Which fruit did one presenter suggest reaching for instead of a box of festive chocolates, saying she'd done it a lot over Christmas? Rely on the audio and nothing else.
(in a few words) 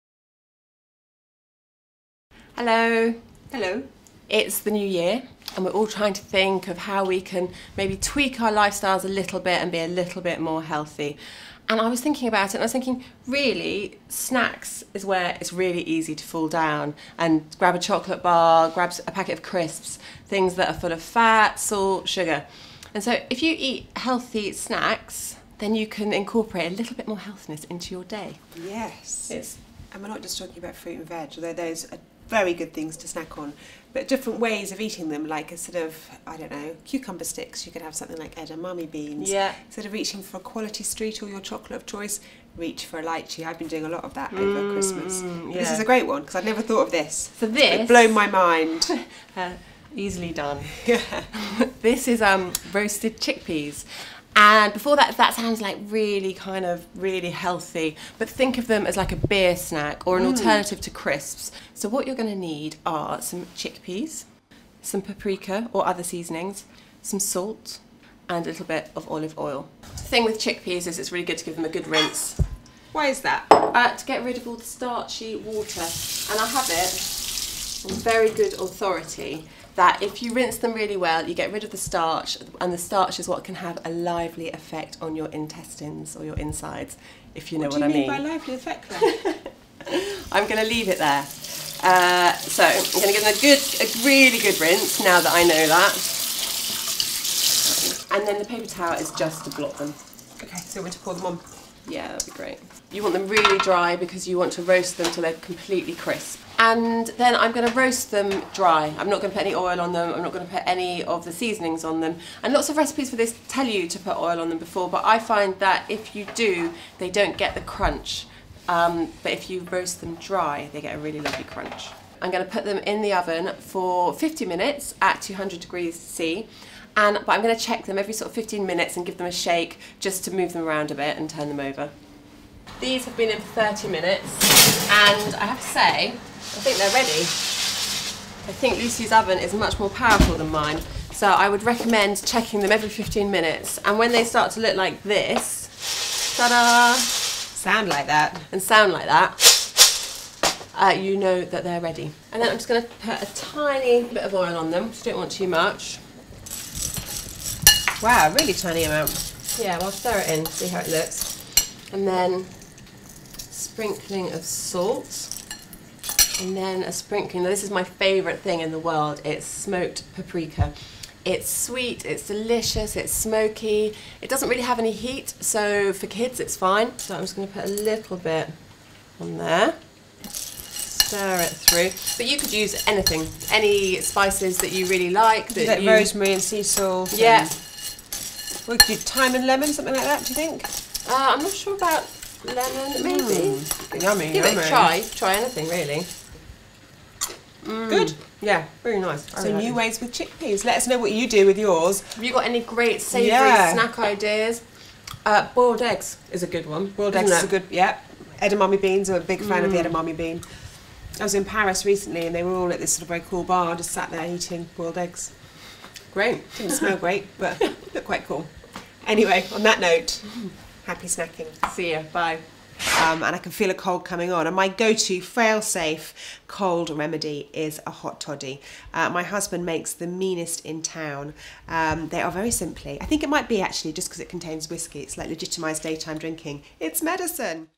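lychee.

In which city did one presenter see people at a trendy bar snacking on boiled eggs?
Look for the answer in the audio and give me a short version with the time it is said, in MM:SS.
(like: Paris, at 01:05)
Paris, at 03:31.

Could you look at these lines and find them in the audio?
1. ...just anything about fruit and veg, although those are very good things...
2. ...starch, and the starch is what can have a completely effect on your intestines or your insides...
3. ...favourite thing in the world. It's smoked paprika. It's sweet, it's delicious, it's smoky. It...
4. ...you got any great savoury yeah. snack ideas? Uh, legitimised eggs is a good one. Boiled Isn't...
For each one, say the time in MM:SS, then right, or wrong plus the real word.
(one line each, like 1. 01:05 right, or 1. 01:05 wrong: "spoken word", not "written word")
1. 00:30 wrong: "talking", not "anything"
2. 01:21 wrong: "lively", not "completely"
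3. 02:47 right
4. 03:22 wrong: "boiled", not "legitimised".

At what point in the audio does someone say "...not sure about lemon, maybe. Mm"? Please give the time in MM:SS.
03:11.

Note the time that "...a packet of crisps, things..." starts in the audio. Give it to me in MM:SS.
00:19.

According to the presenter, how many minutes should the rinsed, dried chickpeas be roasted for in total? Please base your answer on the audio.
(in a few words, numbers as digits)
50 minutes.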